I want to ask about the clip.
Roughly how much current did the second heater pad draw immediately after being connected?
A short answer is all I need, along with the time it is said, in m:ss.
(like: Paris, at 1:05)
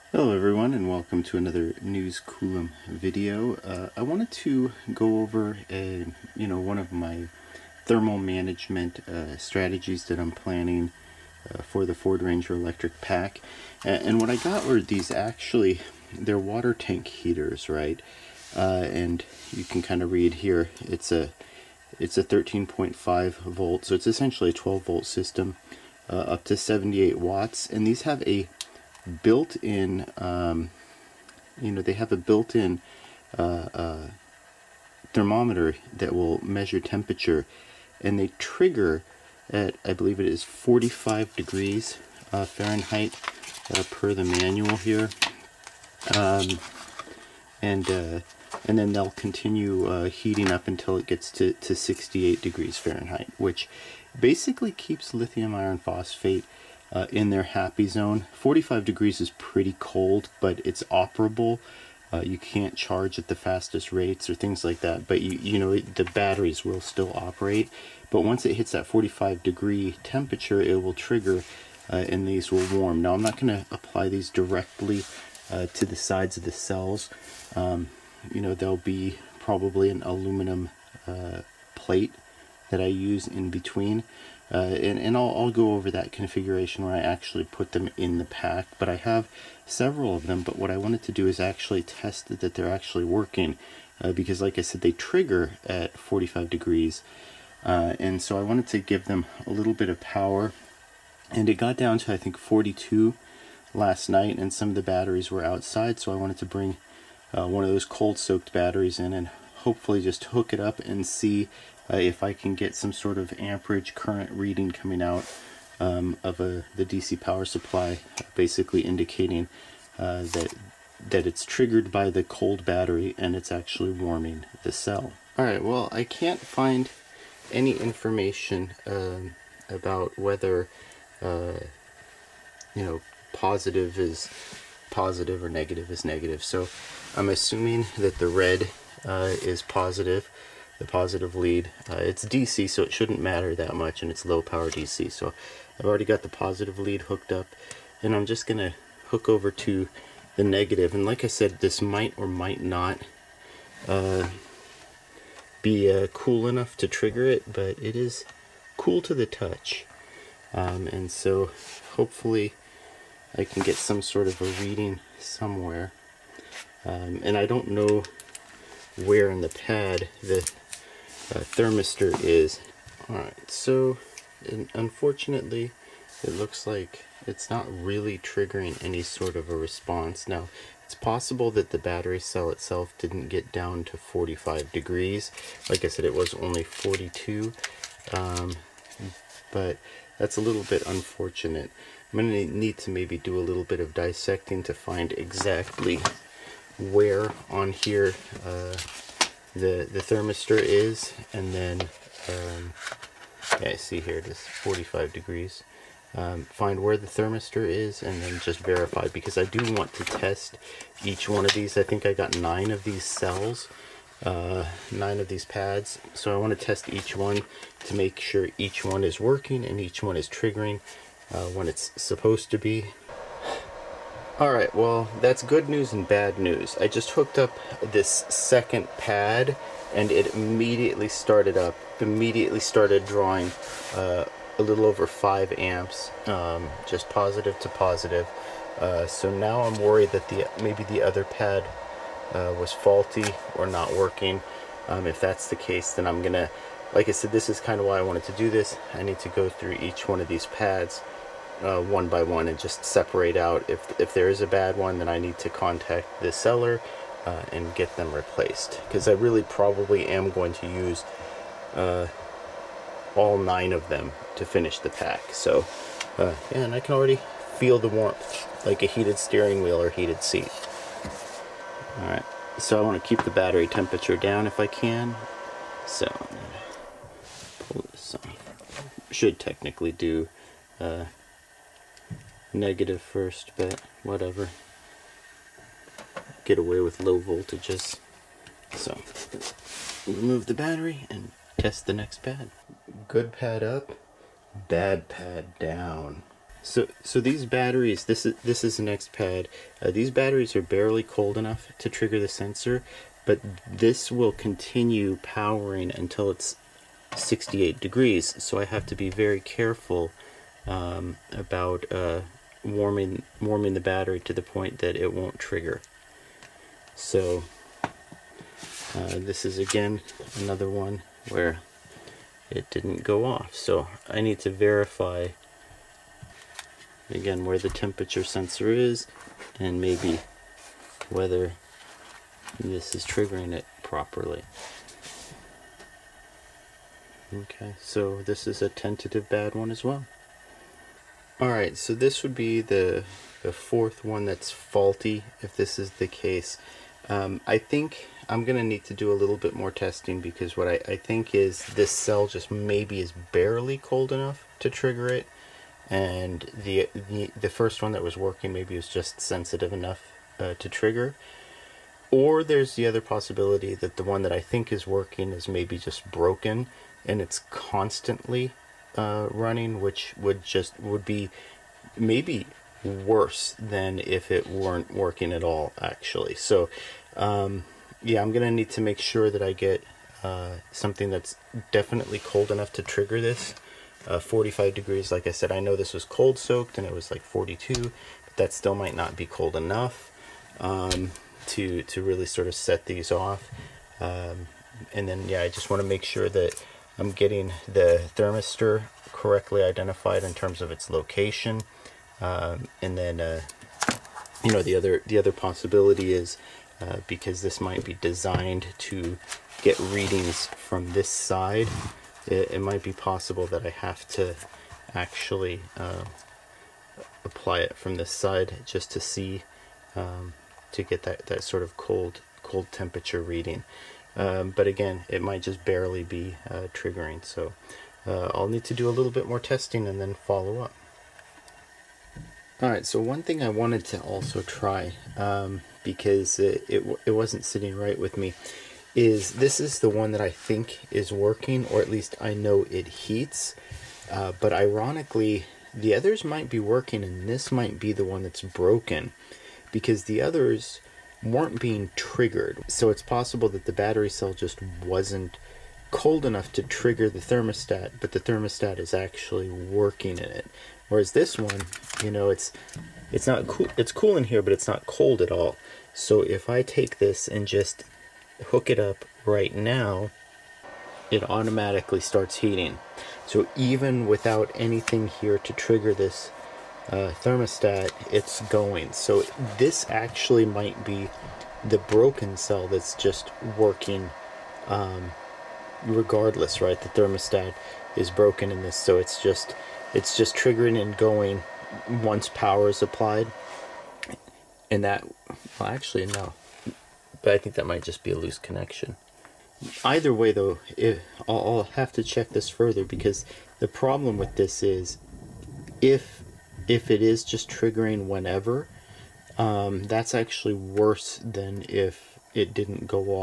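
a little over 5 amps, at 3:54.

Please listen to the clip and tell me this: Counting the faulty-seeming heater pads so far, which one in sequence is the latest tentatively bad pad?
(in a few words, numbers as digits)
fourth.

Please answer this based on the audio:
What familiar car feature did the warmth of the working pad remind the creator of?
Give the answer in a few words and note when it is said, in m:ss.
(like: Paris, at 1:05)
heated steering wheel, at 4:28.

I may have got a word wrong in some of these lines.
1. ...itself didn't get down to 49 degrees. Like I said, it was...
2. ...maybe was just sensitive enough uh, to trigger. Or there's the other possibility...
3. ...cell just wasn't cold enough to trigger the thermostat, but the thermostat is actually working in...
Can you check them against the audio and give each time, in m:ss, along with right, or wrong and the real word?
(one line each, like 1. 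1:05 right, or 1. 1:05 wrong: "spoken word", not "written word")
1. 3:02 wrong: "45", not "49"
2. 5:58 right
3. 7:34 right.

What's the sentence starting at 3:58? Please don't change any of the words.
Uh, so now I'm worried that the maybe the other pad uh, was faulty or not working.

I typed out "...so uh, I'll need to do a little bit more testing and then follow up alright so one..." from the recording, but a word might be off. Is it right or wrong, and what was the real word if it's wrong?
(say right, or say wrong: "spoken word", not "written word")
right.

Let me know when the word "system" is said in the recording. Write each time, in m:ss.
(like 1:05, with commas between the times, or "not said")
0:25.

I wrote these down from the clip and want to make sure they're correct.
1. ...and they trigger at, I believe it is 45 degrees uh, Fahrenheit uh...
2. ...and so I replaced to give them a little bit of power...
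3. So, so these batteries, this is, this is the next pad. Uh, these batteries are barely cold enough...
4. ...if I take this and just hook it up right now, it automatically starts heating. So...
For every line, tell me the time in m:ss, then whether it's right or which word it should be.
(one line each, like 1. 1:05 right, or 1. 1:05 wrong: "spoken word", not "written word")
1. 0:38 right
2. 1:37 wrong: "wanted", not "replaced"
3. 4:56 right
4. 7:46 right.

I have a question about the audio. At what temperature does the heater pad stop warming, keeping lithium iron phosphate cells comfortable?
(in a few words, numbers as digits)
68 degrees Fahrenheit.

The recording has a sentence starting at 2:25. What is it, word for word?
So I've already got the positive lead hooked up, and I'm just going to hook over to the negative.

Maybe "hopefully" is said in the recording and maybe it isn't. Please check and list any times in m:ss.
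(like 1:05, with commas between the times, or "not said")
1:49, 2:41.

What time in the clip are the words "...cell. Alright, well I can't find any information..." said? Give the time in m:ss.
2:04.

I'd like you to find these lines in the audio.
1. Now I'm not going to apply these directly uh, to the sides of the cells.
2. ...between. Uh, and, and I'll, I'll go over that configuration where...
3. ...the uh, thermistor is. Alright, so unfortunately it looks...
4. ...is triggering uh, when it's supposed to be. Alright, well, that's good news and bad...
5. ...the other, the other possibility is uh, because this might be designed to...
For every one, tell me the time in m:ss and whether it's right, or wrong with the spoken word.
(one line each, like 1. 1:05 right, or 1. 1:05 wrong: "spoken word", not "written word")
1. 1:13 right
2. 1:23 right
3. 2:50 right
4. 3:40 right
5. 6:44 right.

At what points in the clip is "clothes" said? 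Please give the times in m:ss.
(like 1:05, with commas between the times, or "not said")
not said.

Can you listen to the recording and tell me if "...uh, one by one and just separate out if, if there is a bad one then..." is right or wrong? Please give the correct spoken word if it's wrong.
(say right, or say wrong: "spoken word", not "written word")
right.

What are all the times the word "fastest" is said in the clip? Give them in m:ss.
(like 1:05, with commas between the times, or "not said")
1:03.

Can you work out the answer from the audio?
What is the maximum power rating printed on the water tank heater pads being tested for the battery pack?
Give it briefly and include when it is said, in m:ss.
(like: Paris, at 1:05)
78 watts, at 0:26.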